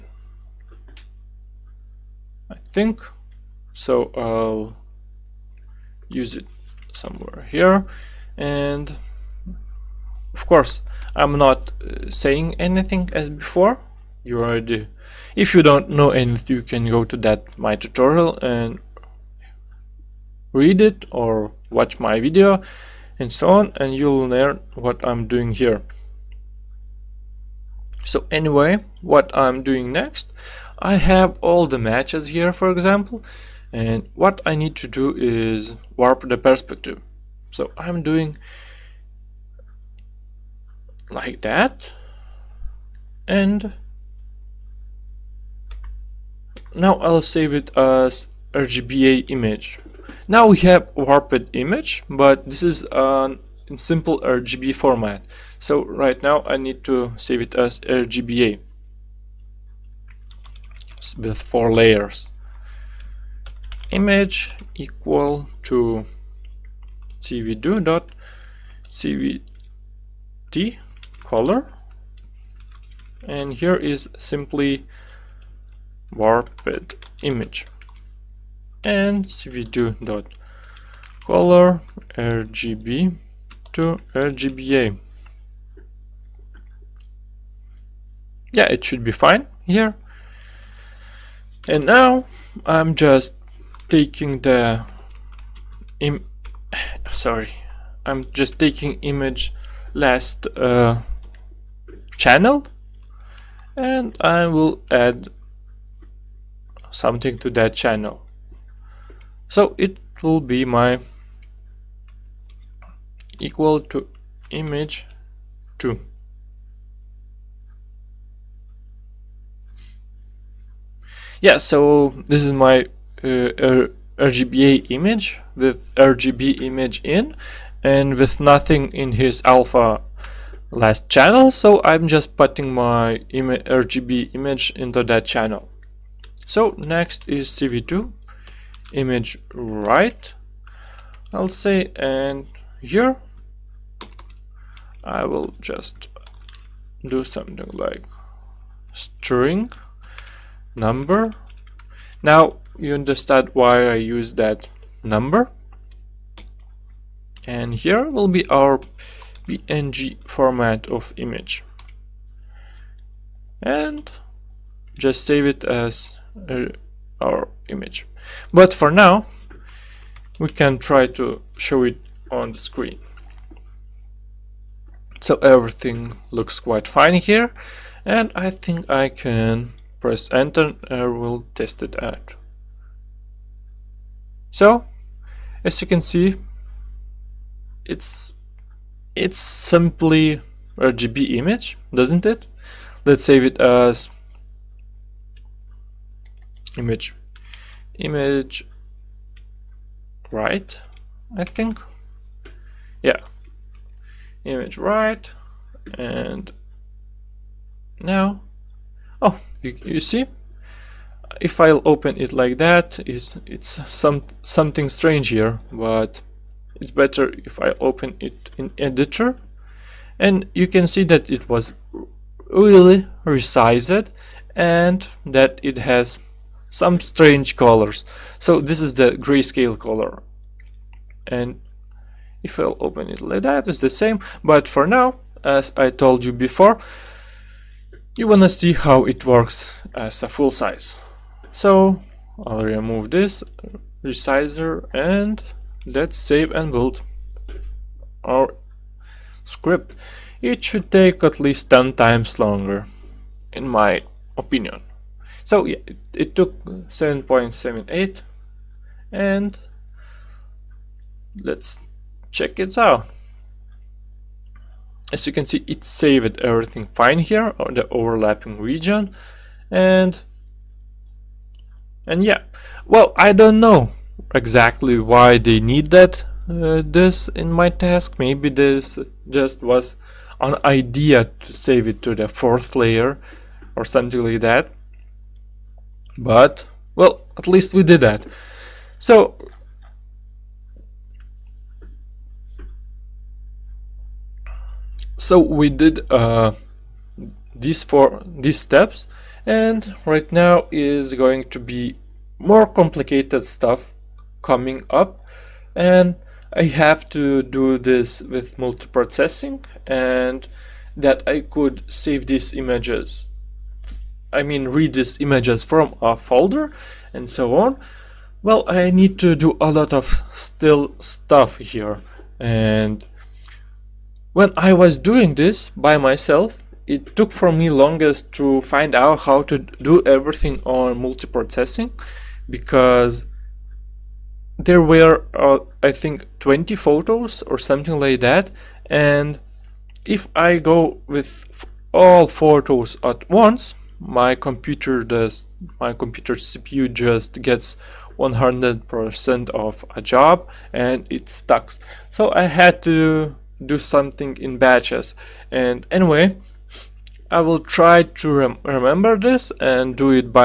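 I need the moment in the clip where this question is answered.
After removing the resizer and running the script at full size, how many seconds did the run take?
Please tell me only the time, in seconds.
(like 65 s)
256 s.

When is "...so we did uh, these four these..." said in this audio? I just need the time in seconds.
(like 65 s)
295 s.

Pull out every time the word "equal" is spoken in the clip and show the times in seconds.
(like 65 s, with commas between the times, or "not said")
64 s, 113 s.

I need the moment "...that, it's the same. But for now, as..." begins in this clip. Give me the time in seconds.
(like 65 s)
233 s.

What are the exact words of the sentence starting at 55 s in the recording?
So right now I need to save it as RGBA with four layers.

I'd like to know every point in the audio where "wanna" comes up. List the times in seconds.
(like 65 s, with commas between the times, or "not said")
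238 s.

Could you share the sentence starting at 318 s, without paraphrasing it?
Well, I need to do a lot of still stuff here.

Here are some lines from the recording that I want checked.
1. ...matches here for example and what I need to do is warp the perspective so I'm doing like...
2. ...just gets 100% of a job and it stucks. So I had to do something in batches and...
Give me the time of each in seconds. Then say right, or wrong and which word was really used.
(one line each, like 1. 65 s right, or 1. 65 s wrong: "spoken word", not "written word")
1. 31 s right
2. 346 s right.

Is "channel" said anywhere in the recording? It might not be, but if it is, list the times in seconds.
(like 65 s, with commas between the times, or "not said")
102 s, 107 s, 131 s, 135 s.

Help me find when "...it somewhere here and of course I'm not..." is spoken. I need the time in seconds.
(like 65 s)
6 s.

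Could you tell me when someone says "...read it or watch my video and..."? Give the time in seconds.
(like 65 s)
20 s.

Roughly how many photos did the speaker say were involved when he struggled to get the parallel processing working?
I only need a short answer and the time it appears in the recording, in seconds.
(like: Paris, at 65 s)
20, at 336 s.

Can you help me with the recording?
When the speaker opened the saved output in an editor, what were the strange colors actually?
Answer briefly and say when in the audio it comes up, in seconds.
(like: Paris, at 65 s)
grayscale, at 229 s.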